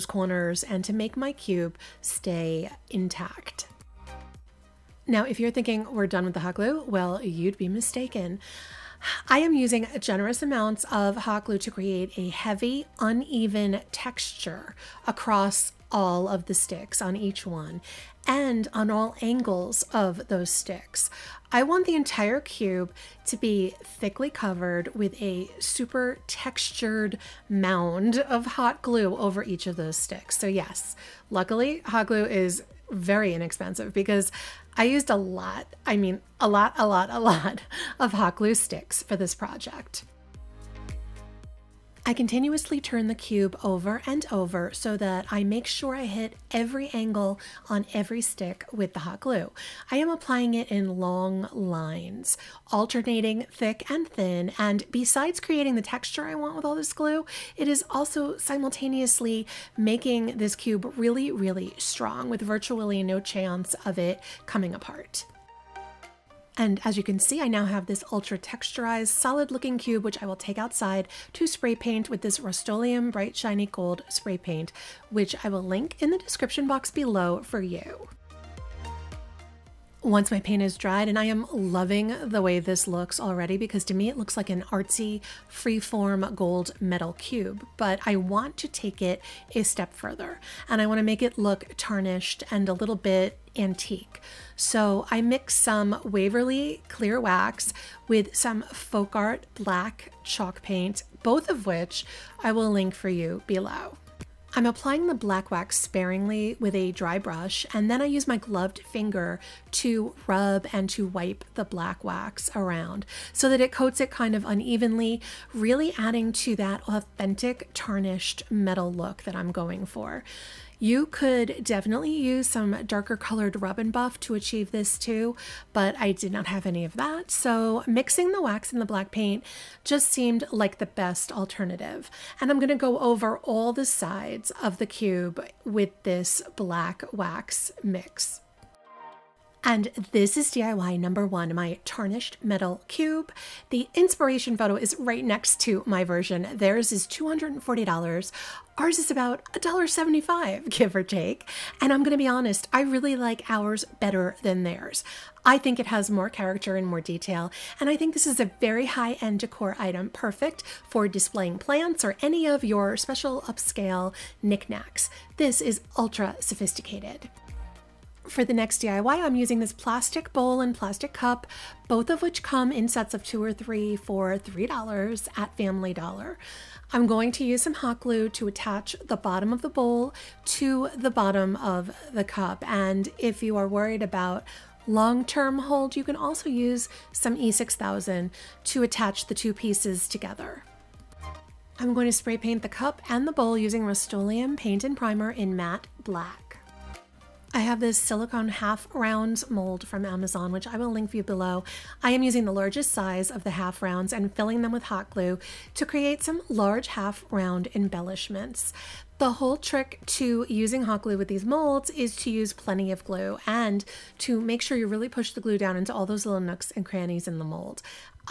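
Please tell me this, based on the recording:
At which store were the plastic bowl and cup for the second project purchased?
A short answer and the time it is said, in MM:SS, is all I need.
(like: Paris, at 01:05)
Family Dollar, at 02:55.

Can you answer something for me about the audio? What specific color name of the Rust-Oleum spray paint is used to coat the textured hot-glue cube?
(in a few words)
Bright Shiny Gold.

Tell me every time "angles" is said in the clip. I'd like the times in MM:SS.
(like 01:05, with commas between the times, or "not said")
00:19, 00:46.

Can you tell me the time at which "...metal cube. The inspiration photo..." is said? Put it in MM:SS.
02:22.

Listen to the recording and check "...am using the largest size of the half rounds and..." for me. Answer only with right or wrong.
right.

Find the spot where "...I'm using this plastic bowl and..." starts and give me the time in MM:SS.
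02:49.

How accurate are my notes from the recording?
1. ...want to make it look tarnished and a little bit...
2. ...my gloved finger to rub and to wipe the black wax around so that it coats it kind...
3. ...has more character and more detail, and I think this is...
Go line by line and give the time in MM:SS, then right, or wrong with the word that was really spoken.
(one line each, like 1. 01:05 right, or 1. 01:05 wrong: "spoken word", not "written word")
1. 01:30 right
2. 01:48 right
3. 02:35 right.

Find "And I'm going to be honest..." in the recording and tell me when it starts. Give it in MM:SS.
02:31.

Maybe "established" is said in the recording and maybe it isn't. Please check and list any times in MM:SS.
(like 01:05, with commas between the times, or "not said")
not said.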